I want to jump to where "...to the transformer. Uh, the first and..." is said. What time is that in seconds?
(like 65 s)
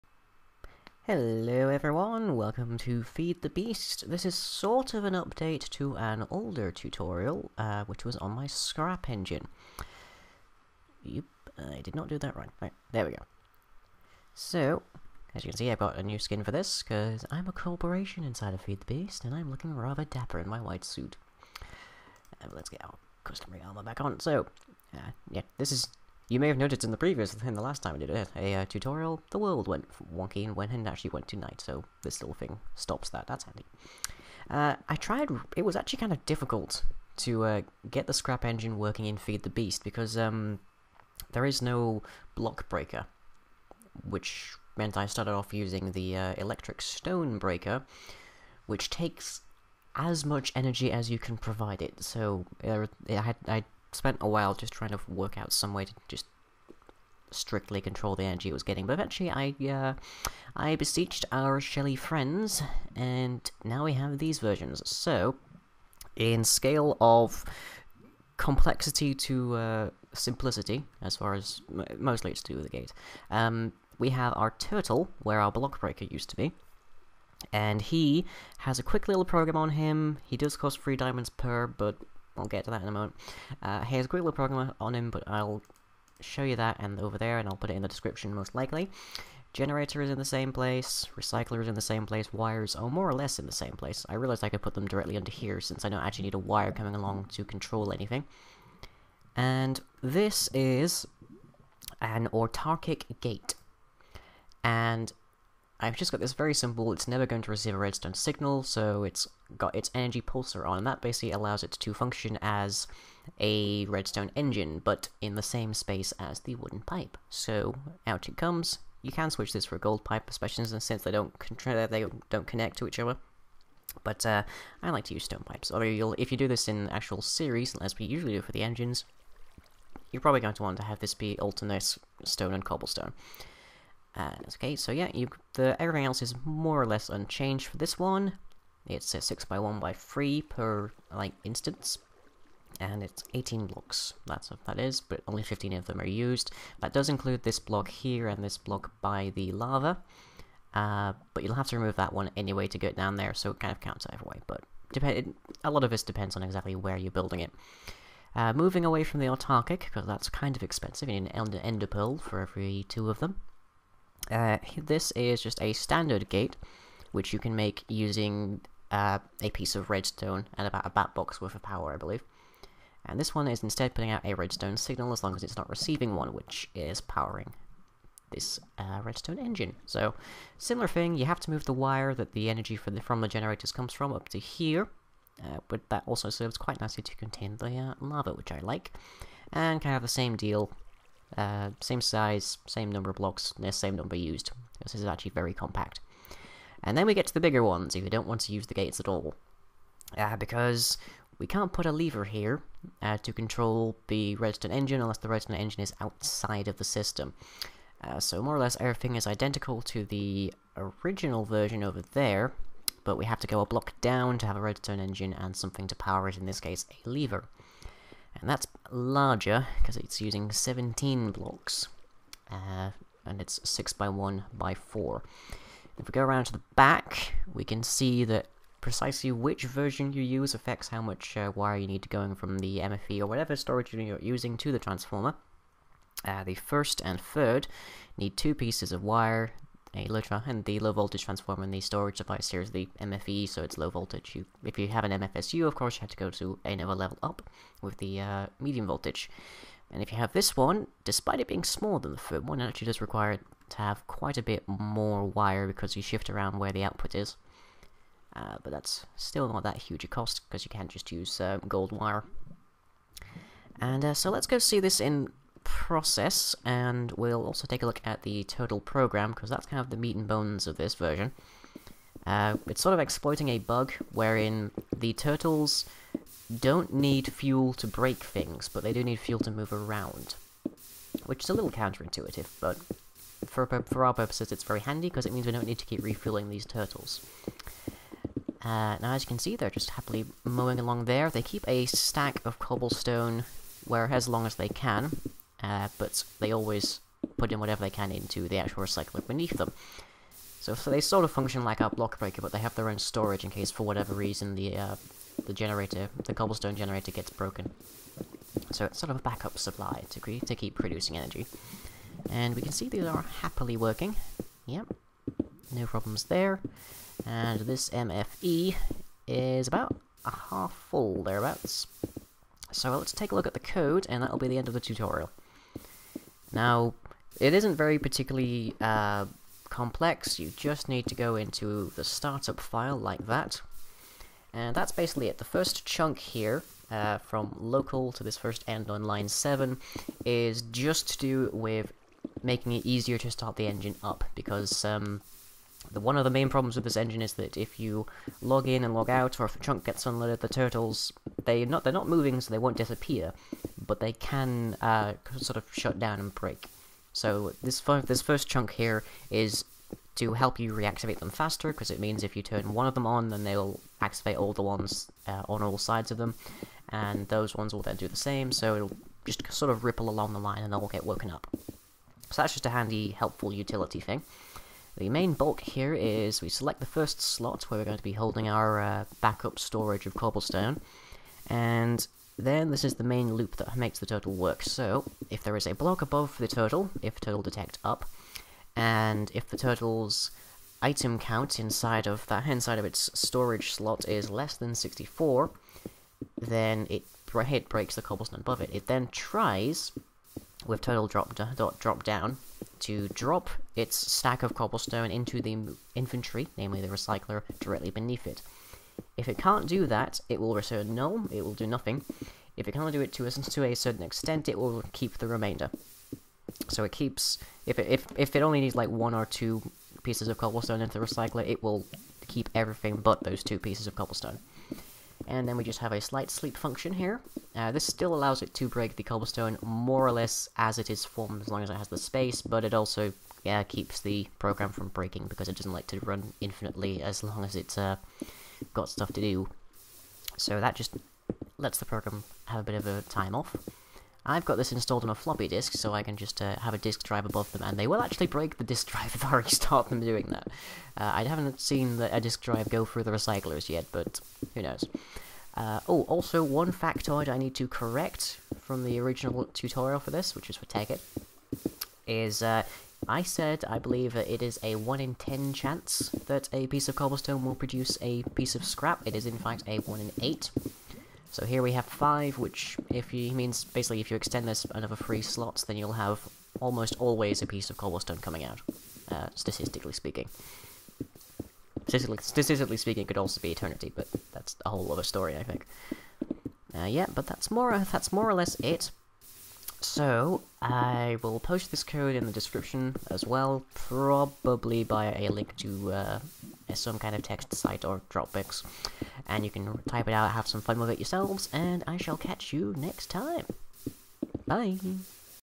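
234 s.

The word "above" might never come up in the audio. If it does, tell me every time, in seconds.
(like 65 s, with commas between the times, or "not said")
386 s, 398 s, 447 s.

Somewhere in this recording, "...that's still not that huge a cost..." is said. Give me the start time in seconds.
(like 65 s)
258 s.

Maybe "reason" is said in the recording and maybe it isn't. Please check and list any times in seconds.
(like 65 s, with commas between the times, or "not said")
304 s.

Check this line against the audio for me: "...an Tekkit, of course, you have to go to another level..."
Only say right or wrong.
wrong.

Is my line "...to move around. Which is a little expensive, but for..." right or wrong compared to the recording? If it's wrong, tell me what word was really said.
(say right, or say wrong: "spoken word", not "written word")
wrong: "counterintuitive", not "expensive".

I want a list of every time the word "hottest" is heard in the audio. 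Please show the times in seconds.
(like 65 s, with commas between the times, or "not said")
not said.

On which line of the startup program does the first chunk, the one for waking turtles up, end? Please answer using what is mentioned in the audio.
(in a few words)
Line 7.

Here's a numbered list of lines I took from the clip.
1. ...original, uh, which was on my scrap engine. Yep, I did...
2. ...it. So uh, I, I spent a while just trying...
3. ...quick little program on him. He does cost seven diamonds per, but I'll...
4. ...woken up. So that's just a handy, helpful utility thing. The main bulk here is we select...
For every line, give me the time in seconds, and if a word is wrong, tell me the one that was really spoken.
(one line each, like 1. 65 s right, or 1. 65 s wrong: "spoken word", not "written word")
1. 6 s wrong: "tutorial", not "original"
2. 51 s right
3. 78 s wrong: "three", not "seven"
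4. 371 s right.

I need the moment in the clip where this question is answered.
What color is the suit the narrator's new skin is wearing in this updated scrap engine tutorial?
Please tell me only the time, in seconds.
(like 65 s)
20 s.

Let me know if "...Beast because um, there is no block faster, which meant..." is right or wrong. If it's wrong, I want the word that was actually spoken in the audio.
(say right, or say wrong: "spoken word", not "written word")
wrong: "breaker", not "faster".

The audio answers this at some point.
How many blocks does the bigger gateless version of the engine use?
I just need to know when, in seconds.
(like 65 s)
220 s.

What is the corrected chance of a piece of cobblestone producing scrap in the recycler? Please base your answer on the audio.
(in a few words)
1 in 8.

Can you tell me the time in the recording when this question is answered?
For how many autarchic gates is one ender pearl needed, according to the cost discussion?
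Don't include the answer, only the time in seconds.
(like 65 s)
162 s.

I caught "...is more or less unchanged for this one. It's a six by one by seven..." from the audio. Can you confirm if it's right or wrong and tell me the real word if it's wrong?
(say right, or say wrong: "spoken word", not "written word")
wrong: "three", not "seven".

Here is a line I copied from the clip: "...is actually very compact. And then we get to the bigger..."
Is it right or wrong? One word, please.
right.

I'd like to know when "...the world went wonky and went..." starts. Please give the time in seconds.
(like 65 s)
29 s.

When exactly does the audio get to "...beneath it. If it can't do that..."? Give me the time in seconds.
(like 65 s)
407 s.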